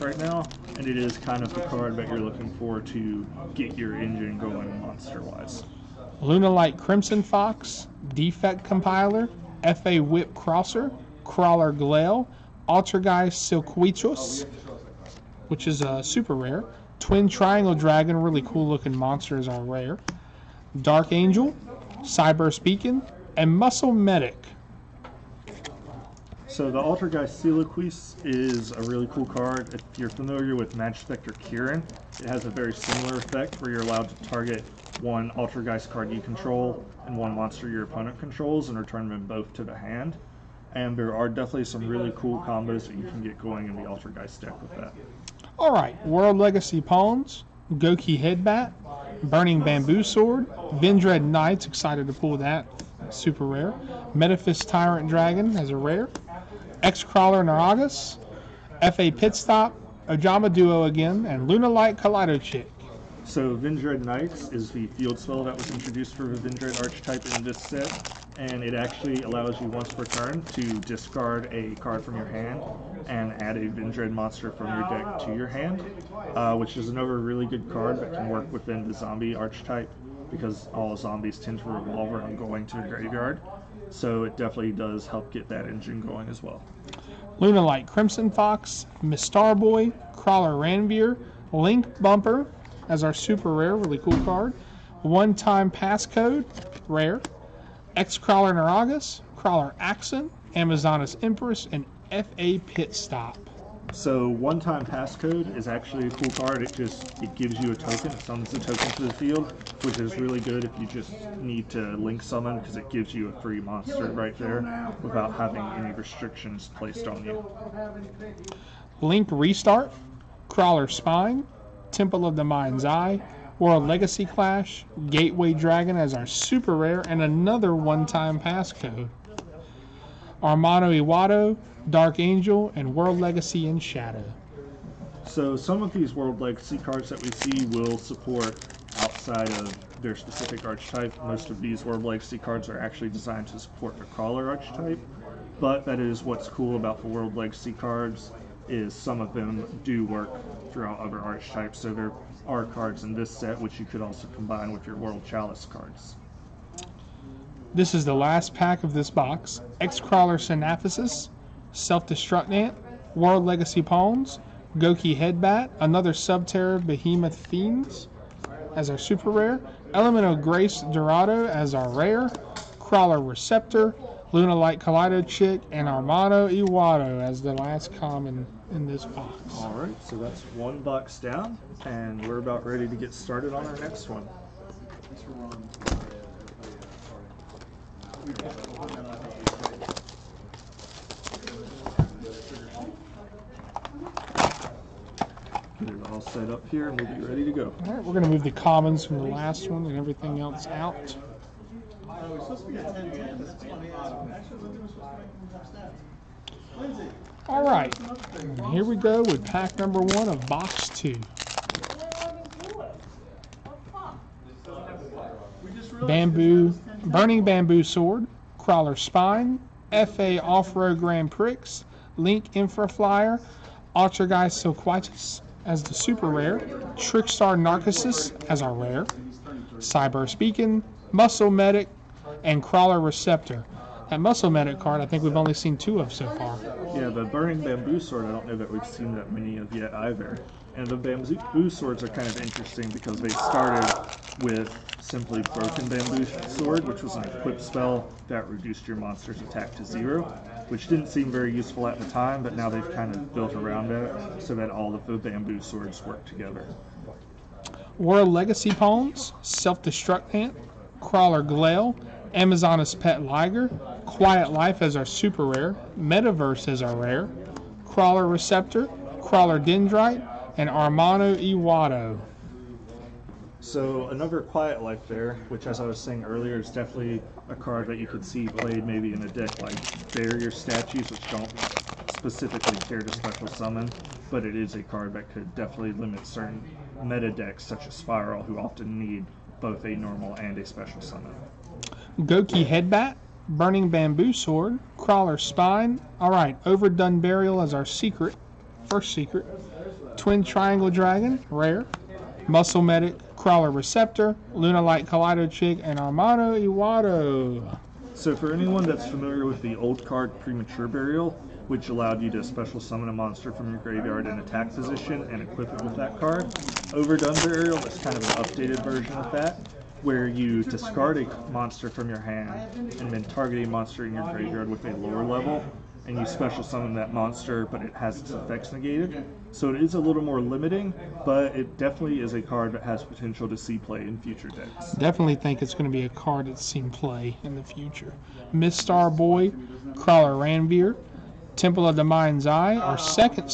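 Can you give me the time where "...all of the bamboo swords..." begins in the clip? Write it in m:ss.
4:14.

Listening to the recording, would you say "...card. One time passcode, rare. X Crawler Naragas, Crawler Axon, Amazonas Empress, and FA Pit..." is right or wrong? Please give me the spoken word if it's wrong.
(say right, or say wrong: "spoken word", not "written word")
right.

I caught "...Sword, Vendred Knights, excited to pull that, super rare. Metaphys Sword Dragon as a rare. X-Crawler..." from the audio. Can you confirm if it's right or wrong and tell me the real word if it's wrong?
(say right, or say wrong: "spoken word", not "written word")
wrong: "Tyrant", not "Sword".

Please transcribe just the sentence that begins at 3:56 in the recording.
Yeah, the burning bamboo sword, I don't know that we've seen that many of yet either.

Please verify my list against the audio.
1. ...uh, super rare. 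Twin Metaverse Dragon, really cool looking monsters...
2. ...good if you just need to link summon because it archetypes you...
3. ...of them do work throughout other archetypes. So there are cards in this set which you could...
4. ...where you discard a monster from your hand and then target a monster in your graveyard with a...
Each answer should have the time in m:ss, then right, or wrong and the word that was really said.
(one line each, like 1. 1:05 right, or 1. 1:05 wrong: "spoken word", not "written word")
1. 0:15 wrong: "Triangle", not "Metaverse"
2. 1:50 wrong: "gives", not "archetypes"
3. 2:29 right
4. 5:20 right.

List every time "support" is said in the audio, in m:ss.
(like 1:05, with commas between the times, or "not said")
2:17, 2:23.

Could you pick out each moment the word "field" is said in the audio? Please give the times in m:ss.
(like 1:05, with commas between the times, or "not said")
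1:04, 1:49.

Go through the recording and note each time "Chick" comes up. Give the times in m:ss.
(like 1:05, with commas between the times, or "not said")
1:02, 2:55, 5:05.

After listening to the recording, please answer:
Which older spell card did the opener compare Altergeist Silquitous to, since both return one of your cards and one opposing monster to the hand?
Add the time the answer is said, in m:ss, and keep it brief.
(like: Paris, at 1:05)
Magic Spectre Kieran, at 0:30.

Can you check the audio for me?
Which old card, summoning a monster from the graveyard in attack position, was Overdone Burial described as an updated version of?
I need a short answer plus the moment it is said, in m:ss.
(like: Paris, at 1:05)
Premature Burial, at 5:10.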